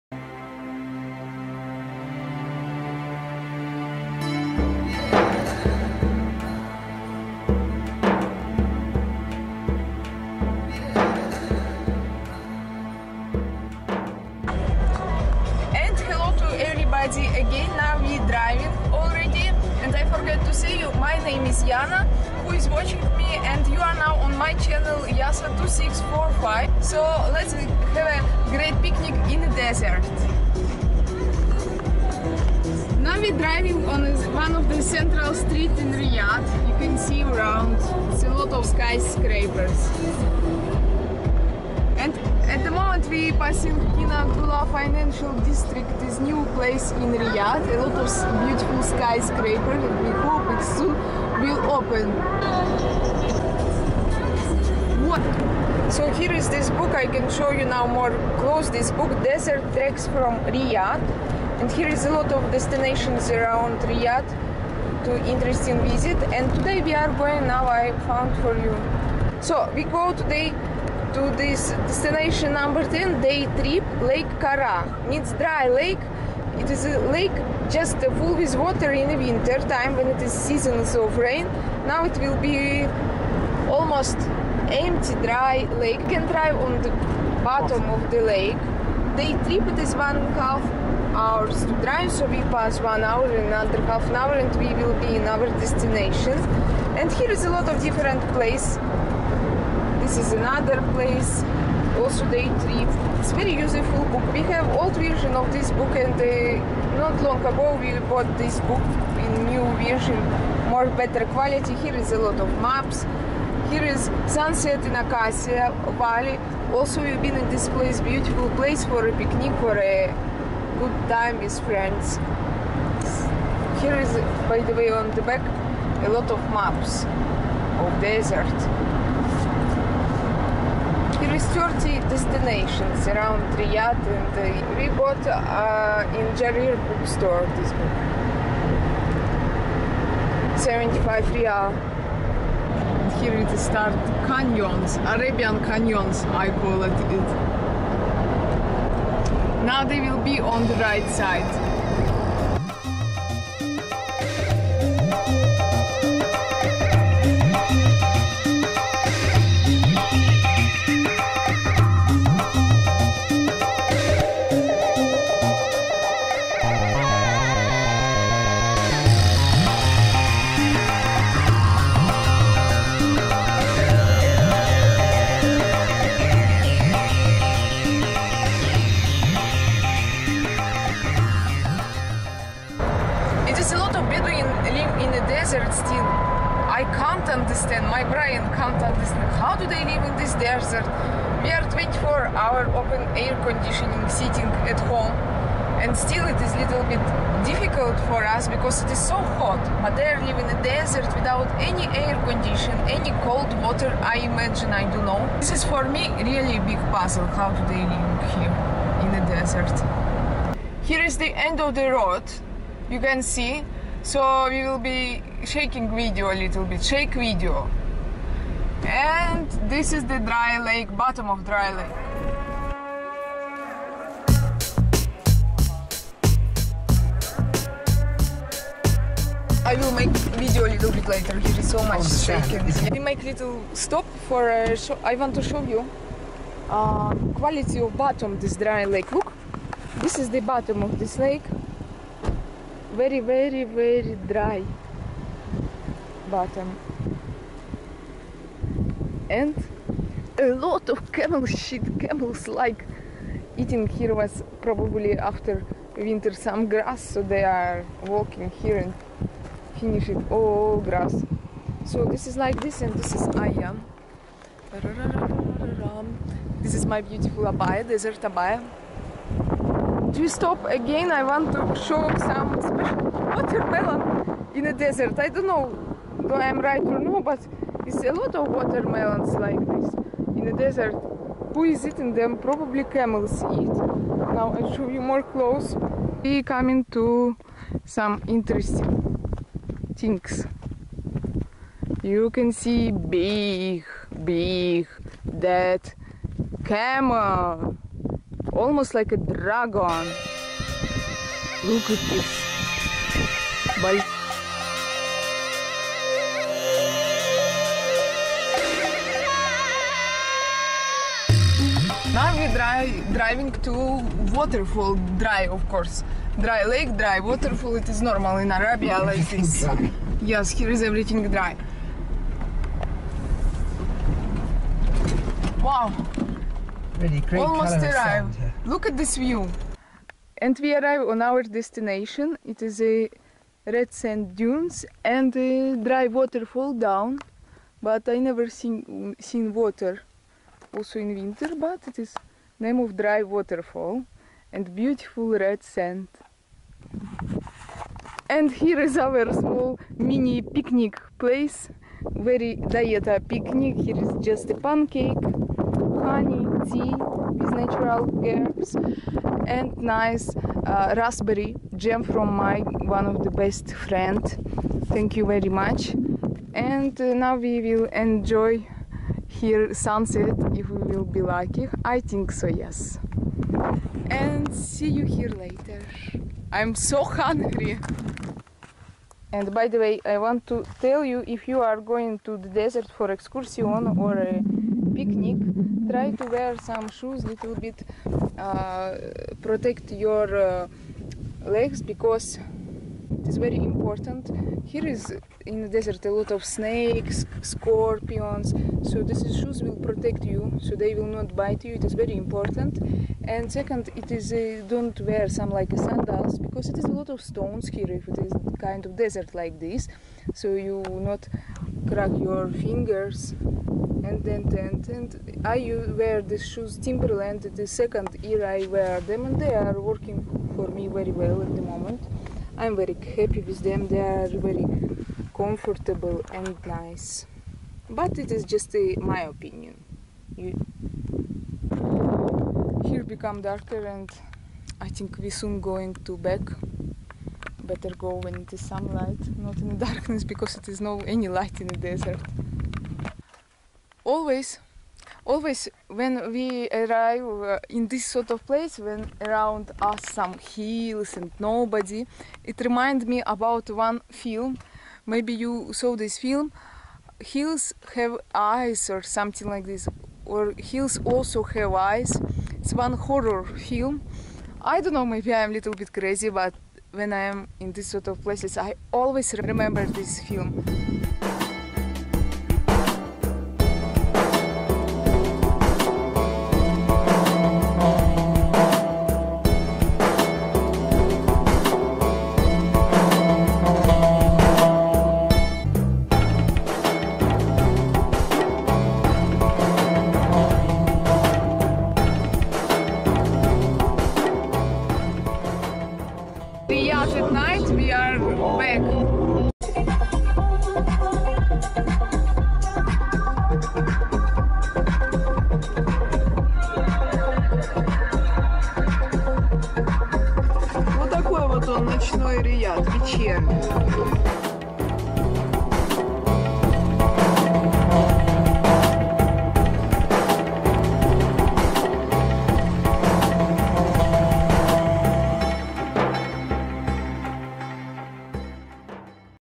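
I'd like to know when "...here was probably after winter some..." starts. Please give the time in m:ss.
4:13.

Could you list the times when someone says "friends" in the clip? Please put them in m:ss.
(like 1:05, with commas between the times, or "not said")
2:01, 6:03.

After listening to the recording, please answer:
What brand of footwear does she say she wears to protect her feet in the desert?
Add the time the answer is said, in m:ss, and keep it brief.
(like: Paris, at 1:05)
Timberland, at 6:56.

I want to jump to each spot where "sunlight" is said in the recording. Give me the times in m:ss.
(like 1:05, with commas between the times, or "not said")
7:18.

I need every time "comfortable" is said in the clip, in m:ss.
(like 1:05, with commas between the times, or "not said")
7:05.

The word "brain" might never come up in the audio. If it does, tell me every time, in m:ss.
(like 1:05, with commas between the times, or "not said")
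3:08.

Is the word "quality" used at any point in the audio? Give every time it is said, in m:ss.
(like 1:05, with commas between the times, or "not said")
1:51, 3:57.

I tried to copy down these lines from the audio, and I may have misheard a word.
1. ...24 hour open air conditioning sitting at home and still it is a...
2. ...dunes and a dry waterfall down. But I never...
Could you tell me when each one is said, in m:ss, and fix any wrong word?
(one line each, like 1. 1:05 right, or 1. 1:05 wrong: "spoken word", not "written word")
1. 3:11 right
2. 5:34 right.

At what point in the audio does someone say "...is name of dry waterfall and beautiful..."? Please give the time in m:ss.
5:41.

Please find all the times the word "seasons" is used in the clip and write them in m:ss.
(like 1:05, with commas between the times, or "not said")
1:20.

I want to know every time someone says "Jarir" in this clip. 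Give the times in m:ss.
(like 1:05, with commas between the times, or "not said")
2:16.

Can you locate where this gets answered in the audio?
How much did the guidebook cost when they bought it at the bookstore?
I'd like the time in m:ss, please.
2:20.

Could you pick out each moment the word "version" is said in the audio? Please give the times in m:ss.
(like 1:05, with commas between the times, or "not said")
1:44, 1:49.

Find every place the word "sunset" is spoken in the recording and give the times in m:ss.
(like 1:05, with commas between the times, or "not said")
1:54, 6:09.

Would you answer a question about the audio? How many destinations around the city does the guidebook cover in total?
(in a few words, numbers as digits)
30.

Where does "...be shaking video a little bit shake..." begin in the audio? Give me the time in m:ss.
3:34.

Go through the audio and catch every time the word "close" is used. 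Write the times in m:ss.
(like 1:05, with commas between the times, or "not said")
0:58, 4:45.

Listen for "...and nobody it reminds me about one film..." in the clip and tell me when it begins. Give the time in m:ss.
7:31.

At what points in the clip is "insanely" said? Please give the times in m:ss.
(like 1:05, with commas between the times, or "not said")
not said.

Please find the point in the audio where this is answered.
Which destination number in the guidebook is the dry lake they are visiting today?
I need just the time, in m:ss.
1:12.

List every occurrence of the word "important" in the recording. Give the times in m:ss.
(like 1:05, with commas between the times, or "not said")
6:33, 6:42.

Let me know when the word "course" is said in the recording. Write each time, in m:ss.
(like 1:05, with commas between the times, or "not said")
5:15.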